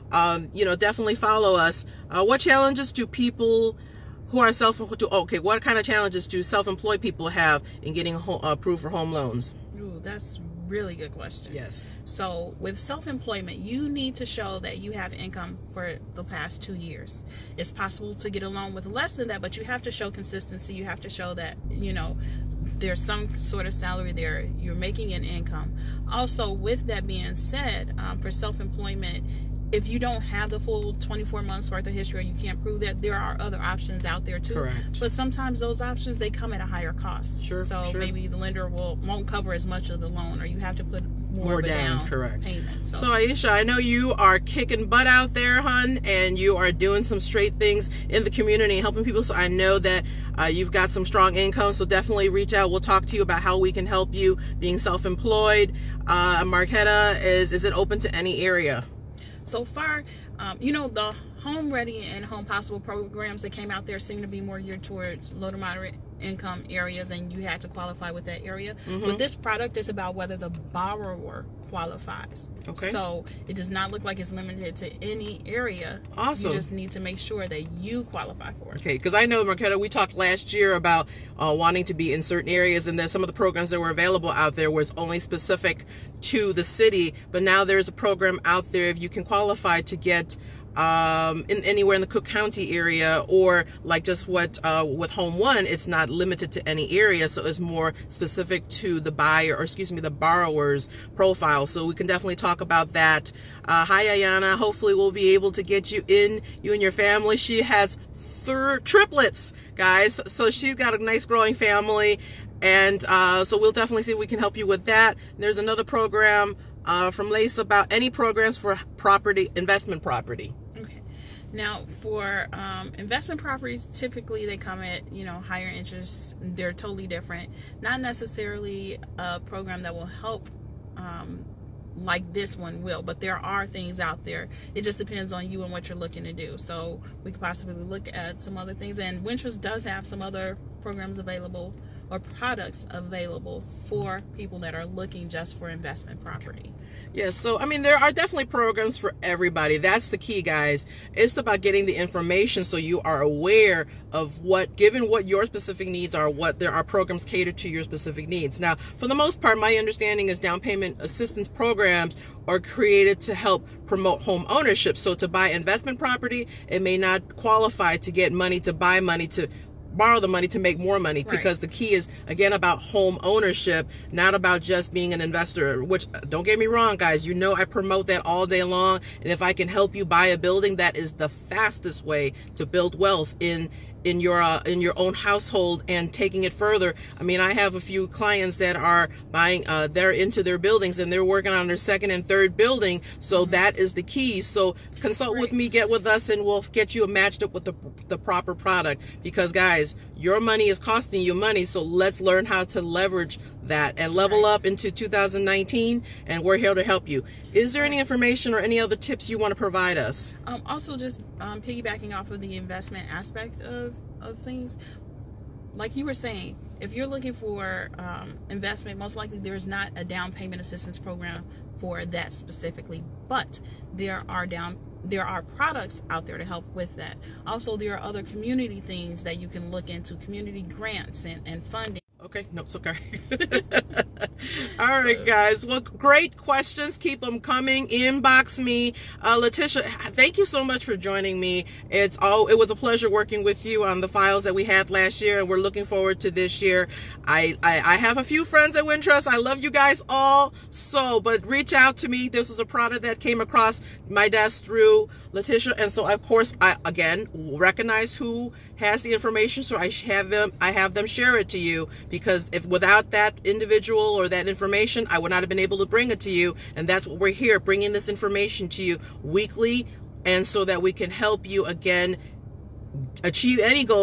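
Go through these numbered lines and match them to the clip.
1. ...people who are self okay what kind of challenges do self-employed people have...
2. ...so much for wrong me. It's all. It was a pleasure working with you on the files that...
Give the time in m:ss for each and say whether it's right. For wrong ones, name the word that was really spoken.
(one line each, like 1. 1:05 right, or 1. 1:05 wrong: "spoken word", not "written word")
1. 0:03 right
2. 4:00 wrong: "joining", not "wrong".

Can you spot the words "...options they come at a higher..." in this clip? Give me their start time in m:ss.
0:35.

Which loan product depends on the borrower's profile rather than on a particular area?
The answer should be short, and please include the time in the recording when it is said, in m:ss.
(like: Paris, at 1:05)
Home One, at 1:35.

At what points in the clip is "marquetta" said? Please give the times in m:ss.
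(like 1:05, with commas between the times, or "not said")
0:56, 1:19.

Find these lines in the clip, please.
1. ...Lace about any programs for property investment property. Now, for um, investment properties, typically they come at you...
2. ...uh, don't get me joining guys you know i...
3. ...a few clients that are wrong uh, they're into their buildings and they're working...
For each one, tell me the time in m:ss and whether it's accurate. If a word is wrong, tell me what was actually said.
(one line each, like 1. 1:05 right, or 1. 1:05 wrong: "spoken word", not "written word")
1. 1:57 right
2. 2:56 wrong: "wrong", not "joining"
3. 3:07 wrong: "buying", not "wrong".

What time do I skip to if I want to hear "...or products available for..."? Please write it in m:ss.
2:22.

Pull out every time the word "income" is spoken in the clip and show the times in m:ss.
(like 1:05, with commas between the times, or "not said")
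0:15, 0:25, 0:51, 1:06.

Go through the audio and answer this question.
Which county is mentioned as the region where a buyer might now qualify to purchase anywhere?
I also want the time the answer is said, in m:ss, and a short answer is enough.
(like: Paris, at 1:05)
Cook County, at 1:32.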